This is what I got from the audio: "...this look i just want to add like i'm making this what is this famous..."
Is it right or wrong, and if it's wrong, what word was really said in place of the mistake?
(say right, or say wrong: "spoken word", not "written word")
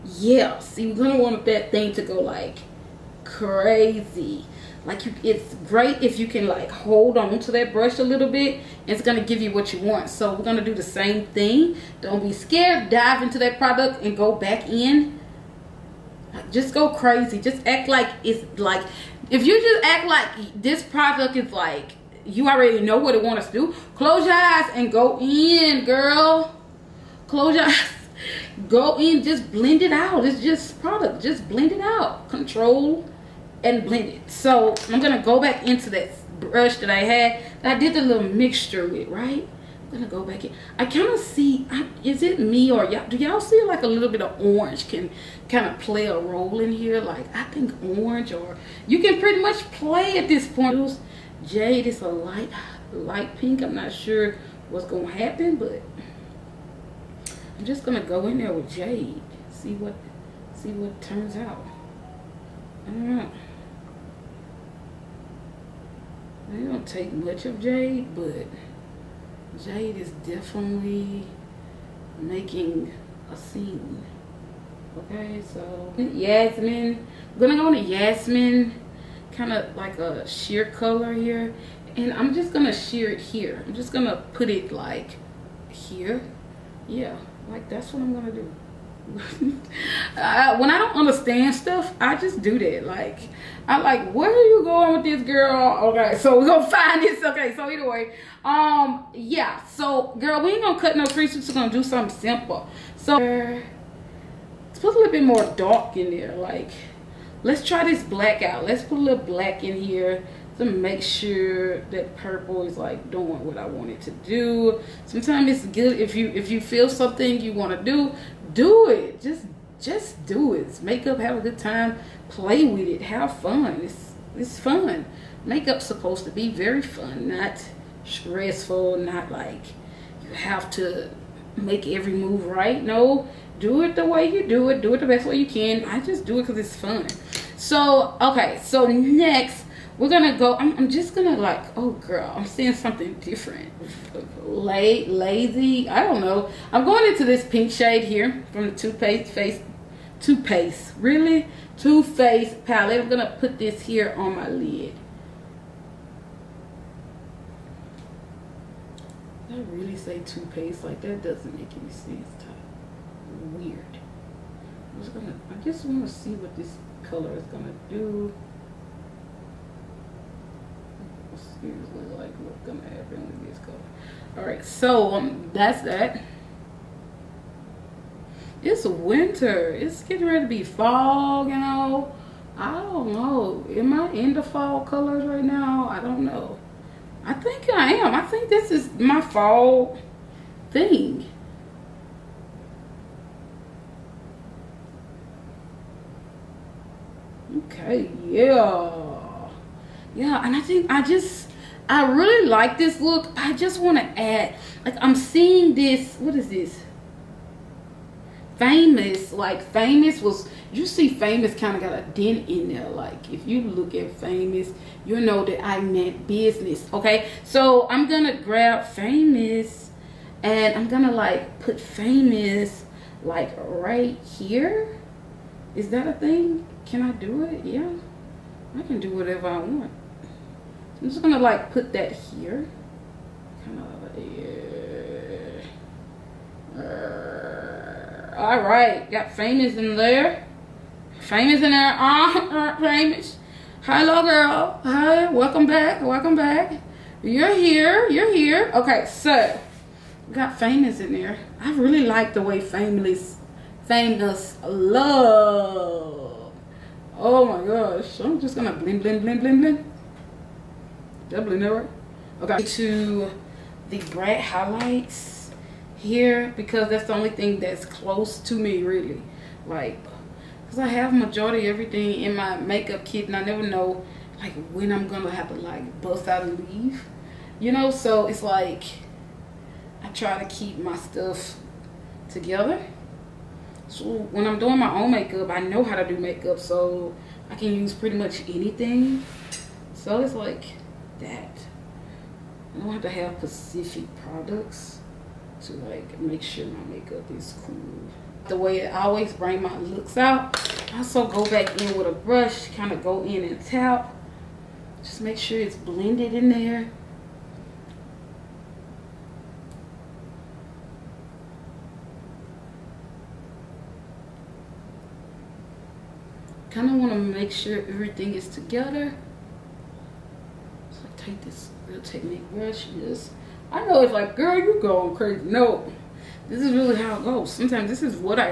wrong: "seeing", not "making".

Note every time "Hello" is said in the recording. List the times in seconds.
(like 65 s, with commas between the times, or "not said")
243 s.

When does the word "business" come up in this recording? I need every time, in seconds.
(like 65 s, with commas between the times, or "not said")
216 s.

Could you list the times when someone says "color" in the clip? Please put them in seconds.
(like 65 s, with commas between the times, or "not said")
80 s, 167 s, 173 s, 184 s.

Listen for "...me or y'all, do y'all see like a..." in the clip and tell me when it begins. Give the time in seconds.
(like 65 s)
42 s.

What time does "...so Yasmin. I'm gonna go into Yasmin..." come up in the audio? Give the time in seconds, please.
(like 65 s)
75 s.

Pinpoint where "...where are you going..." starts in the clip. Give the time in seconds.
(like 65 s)
94 s.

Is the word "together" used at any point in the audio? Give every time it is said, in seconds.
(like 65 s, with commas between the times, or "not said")
282 s, 318 s.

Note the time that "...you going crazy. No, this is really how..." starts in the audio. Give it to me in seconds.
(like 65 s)
324 s.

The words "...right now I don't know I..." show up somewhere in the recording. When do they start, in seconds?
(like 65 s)
185 s.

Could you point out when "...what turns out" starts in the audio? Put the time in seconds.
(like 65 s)
60 s.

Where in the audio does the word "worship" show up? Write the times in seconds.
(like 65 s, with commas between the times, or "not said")
not said.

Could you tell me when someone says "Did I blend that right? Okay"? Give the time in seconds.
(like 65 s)
261 s.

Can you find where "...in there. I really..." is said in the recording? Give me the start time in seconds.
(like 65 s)
251 s.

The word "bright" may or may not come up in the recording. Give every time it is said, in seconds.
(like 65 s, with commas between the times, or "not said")
264 s.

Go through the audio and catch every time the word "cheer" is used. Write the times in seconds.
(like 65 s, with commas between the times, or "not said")
not said.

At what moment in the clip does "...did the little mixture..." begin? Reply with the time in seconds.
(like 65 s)
37 s.